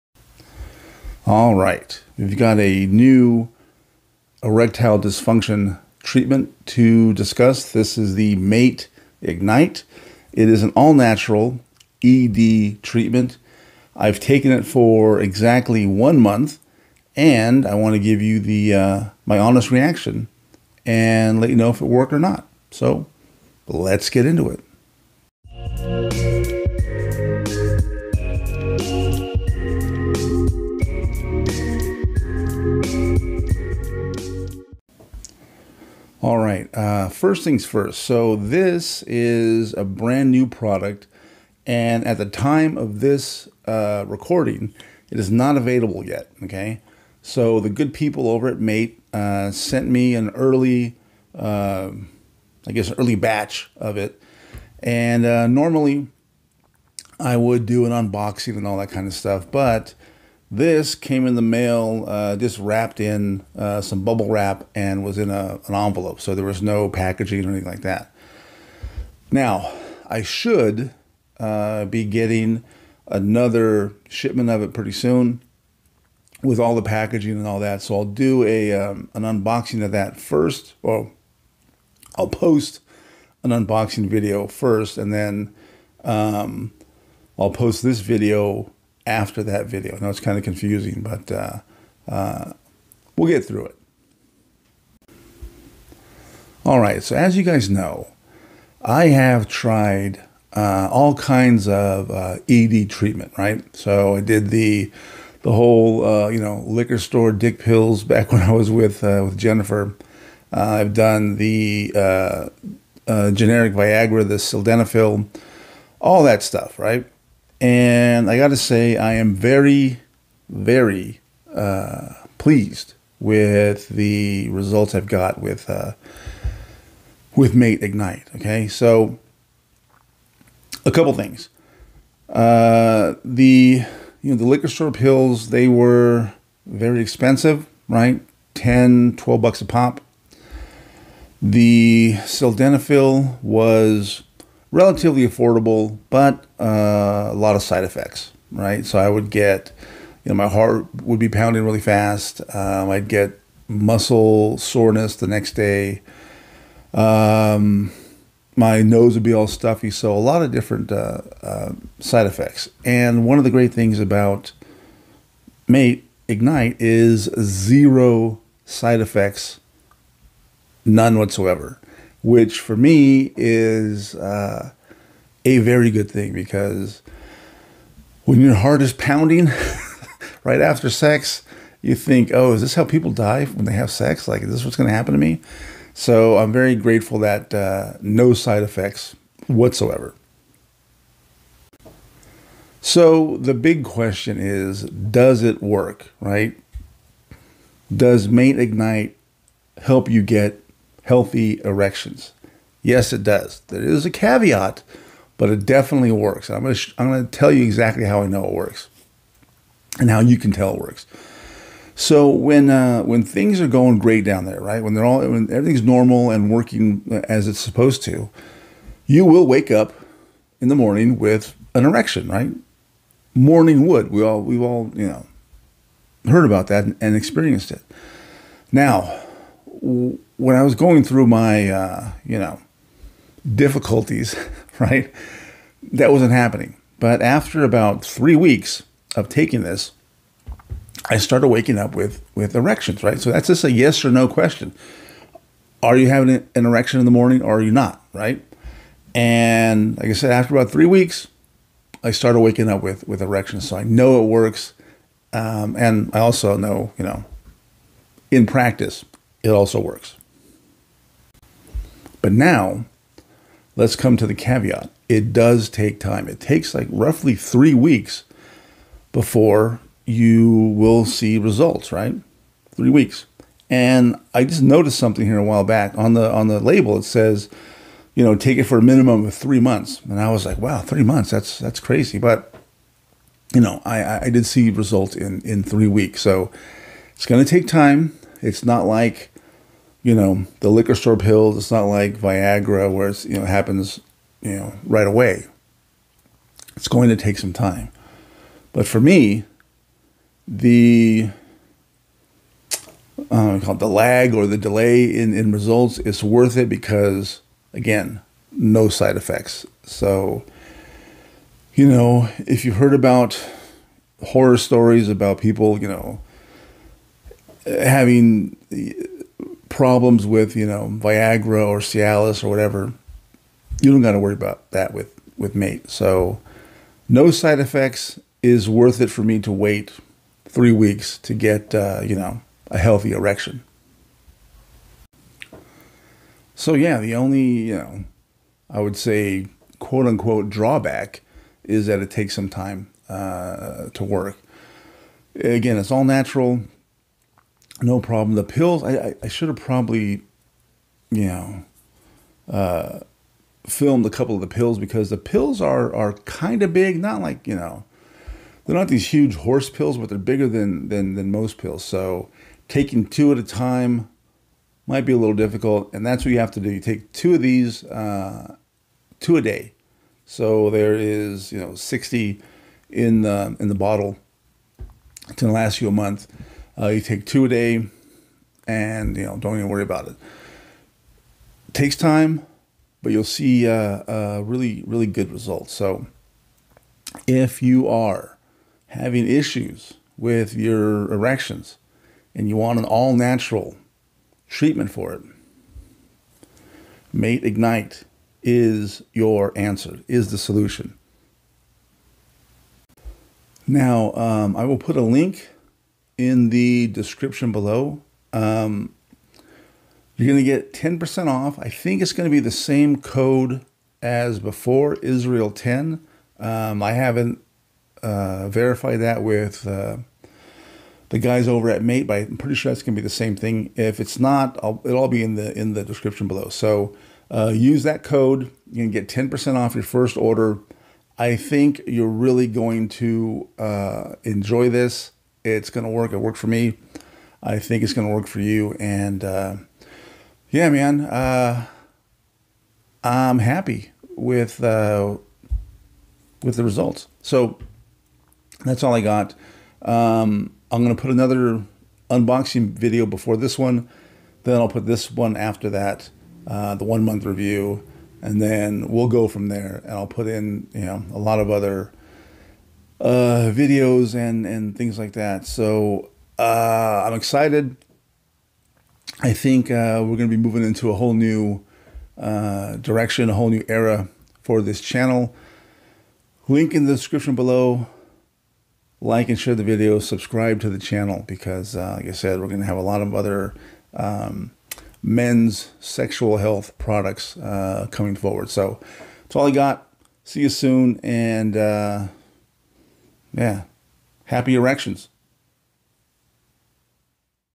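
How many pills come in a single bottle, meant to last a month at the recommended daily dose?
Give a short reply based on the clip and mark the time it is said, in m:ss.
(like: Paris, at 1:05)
60, at 6:11.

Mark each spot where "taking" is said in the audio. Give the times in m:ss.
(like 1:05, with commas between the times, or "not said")
3:59, 6:02.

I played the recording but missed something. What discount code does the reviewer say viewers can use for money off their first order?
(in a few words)
Israel 10.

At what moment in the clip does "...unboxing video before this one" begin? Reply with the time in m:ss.
7:32.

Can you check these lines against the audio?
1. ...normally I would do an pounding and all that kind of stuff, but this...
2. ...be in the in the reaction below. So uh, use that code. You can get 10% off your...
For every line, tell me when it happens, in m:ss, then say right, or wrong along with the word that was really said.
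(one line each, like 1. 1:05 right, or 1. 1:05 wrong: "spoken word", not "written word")
1. 0:55 wrong: "unboxing", not "pounding"
2. 7:05 wrong: "description", not "reaction".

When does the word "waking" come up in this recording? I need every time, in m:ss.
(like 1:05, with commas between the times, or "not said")
4:01, 4:12.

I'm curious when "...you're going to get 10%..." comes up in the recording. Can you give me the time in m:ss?
6:50.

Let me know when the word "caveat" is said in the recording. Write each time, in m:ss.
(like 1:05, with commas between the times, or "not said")
3:24, 4:24.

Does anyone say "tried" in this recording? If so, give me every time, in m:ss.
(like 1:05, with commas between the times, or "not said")
1:39.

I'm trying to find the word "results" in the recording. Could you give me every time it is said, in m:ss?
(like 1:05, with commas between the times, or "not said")
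2:04, 4:31, 4:44, 5:05, 6:25, 7:26.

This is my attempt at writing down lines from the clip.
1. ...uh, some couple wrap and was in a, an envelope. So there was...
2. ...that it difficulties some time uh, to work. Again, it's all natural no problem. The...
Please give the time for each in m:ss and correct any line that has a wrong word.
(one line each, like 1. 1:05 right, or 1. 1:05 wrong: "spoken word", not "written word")
1. 1:03 wrong: "bubble", not "couple"
2. 5:41 wrong: "takes", not "difficulties".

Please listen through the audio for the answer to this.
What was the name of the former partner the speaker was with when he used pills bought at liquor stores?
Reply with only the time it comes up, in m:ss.
1:49.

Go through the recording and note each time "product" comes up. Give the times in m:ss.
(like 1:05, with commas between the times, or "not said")
0:40, 8:06.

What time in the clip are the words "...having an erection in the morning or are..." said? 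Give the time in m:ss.
4:06.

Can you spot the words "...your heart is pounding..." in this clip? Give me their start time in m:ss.
2:58.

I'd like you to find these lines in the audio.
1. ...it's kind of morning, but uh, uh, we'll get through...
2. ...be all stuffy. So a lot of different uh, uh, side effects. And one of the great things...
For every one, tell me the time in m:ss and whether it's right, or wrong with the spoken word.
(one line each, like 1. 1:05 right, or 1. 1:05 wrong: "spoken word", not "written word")
1. 1:30 wrong: "confusing", not "morning"
2. 2:39 right.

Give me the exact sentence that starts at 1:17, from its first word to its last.
So I'll do a um, an unboxing of that first.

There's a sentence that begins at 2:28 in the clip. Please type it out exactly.
So I would get, you know, my heart would be pounding really fast.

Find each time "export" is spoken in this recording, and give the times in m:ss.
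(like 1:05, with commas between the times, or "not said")
not said.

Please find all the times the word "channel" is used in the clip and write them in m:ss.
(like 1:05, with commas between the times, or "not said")
7:54, 8:00.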